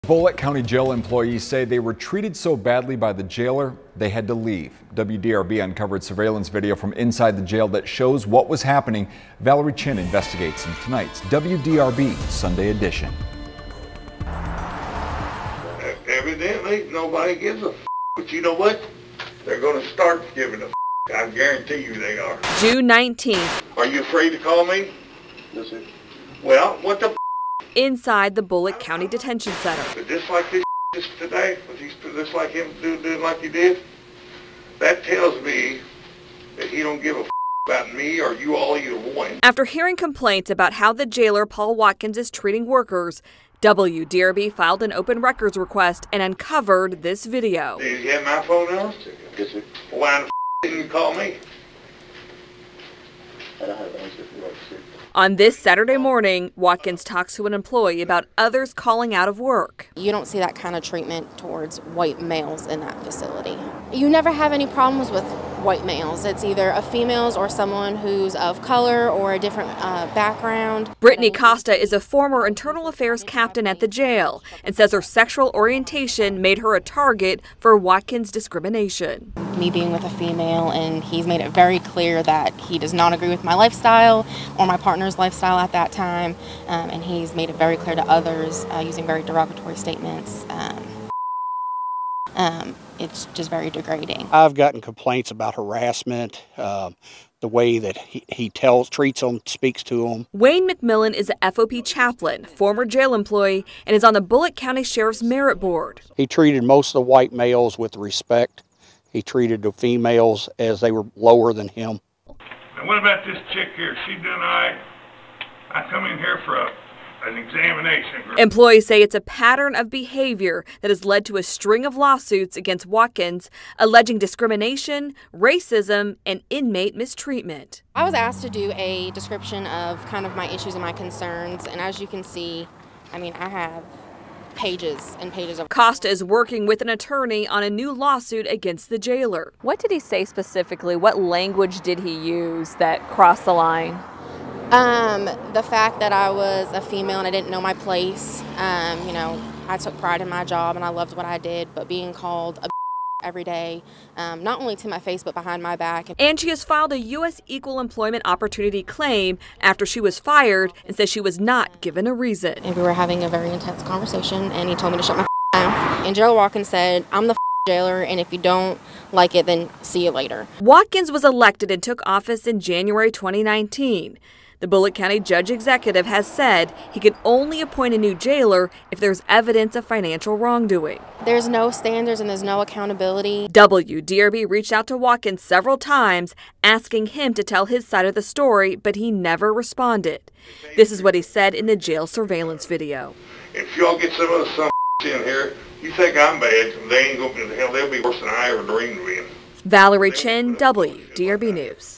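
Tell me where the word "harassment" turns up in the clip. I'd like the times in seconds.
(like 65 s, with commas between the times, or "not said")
95 s.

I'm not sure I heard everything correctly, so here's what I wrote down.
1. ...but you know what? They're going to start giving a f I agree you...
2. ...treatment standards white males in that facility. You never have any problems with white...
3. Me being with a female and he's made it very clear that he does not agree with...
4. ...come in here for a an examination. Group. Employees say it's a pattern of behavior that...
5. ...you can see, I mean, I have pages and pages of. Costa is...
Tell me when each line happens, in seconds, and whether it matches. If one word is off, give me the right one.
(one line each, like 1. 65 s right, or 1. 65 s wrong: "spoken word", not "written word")
1. 18 s wrong: "guarantee", not "agree"
2. 60 s wrong: "towards", not "standards"
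3. 79 s right
4. 115 s right
5. 132 s right.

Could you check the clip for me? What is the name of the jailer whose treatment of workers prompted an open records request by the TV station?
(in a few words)
Paul Watkins.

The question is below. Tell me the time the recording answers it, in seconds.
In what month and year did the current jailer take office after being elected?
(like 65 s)
172 s.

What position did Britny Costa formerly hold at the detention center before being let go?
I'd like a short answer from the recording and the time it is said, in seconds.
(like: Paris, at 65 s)
internal affairs captain, at 72 s.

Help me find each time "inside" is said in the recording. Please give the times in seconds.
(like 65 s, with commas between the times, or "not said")
6 s, 27 s.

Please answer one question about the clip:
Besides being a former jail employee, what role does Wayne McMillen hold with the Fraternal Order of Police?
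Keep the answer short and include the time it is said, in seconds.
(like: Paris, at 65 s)
chaplain, at 101 s.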